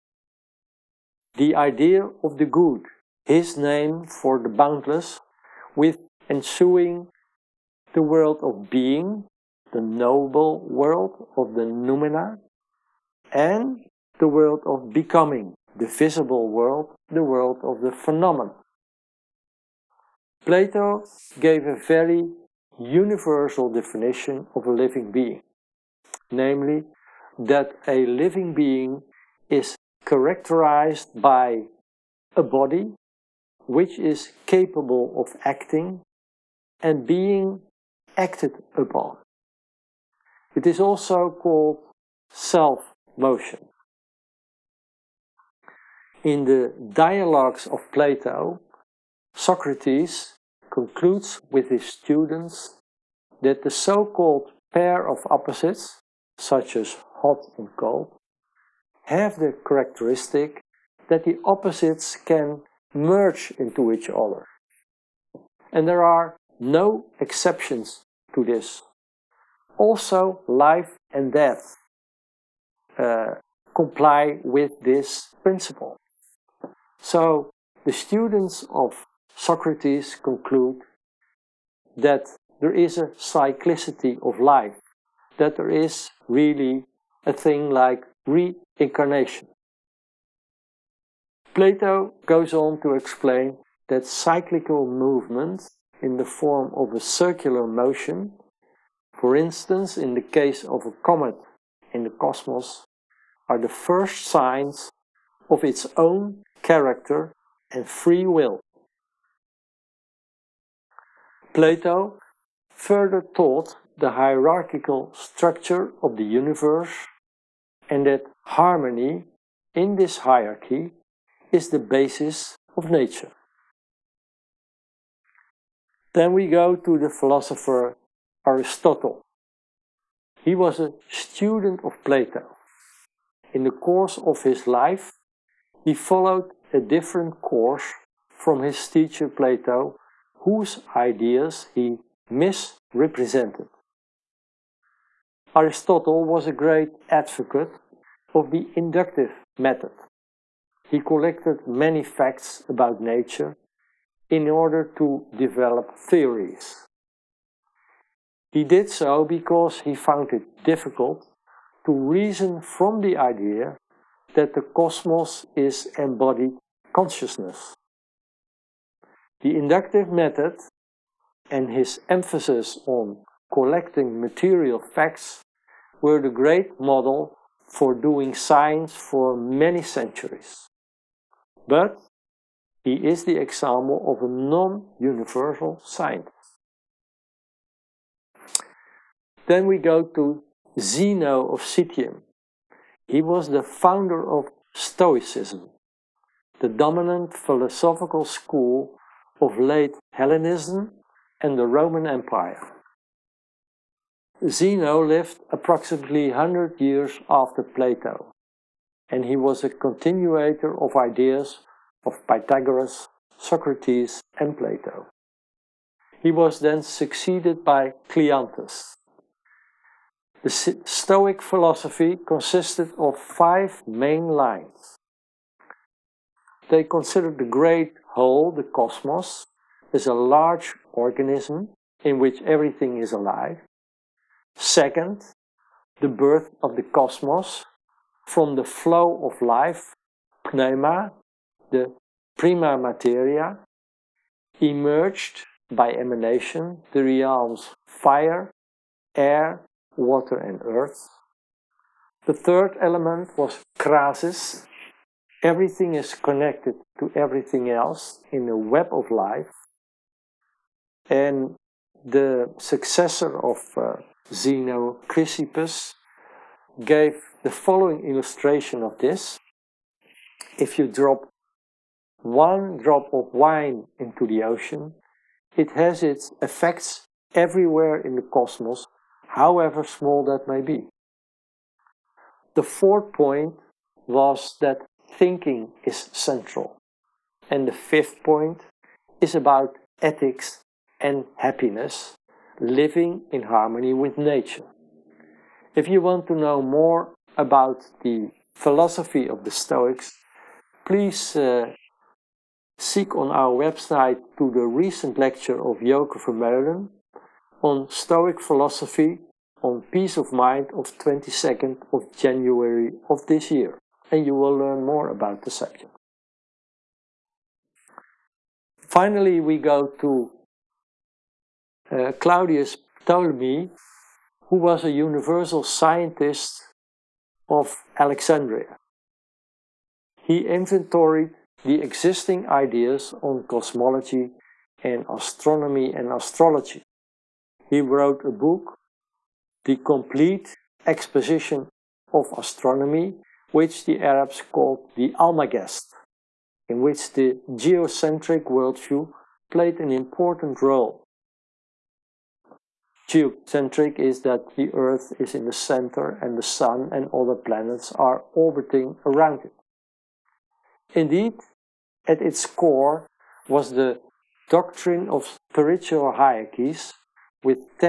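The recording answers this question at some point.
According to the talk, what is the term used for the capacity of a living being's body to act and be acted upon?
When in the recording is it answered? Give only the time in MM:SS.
00:42.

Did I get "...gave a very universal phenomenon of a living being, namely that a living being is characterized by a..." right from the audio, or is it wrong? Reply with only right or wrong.
wrong.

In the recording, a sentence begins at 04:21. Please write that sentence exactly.
And the successor of uh, Zeno, Chrysippus, gave the following illustration of this.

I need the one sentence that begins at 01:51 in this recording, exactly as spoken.
Plato further taught the hierarchical structure of the universe and that harmony in this hierarchy is the basis of nature.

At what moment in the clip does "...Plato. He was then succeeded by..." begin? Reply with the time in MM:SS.
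03:34.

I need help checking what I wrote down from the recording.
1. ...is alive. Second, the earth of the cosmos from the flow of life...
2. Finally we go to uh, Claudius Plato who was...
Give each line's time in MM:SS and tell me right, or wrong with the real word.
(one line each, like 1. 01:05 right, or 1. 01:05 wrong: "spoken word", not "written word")
1. 03:52 wrong: "birth", not "earth"
2. 05:18 wrong: "Ptolemy", not "Plato".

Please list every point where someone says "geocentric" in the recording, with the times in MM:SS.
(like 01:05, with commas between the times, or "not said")
05:47, 05:53.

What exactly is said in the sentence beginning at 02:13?
In the course of his life, he followed a different course from his teacher Plato, whose ideas he misrepresented.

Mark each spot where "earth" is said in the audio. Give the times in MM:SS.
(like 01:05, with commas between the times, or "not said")
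04:10, 05:54.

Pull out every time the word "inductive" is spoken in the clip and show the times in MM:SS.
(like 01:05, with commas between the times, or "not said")
02:28, 02:49.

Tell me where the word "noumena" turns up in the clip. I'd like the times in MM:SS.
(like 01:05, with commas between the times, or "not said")
00:11.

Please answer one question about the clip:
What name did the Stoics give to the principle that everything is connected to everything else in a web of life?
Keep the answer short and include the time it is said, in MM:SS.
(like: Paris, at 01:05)
Krasis, at 04:13.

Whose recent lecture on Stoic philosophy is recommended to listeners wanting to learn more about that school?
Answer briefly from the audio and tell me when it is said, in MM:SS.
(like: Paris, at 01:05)
Joke Vermeulen, at 05:05.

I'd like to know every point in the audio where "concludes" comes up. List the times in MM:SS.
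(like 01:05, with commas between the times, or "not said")
00:50, 01:20.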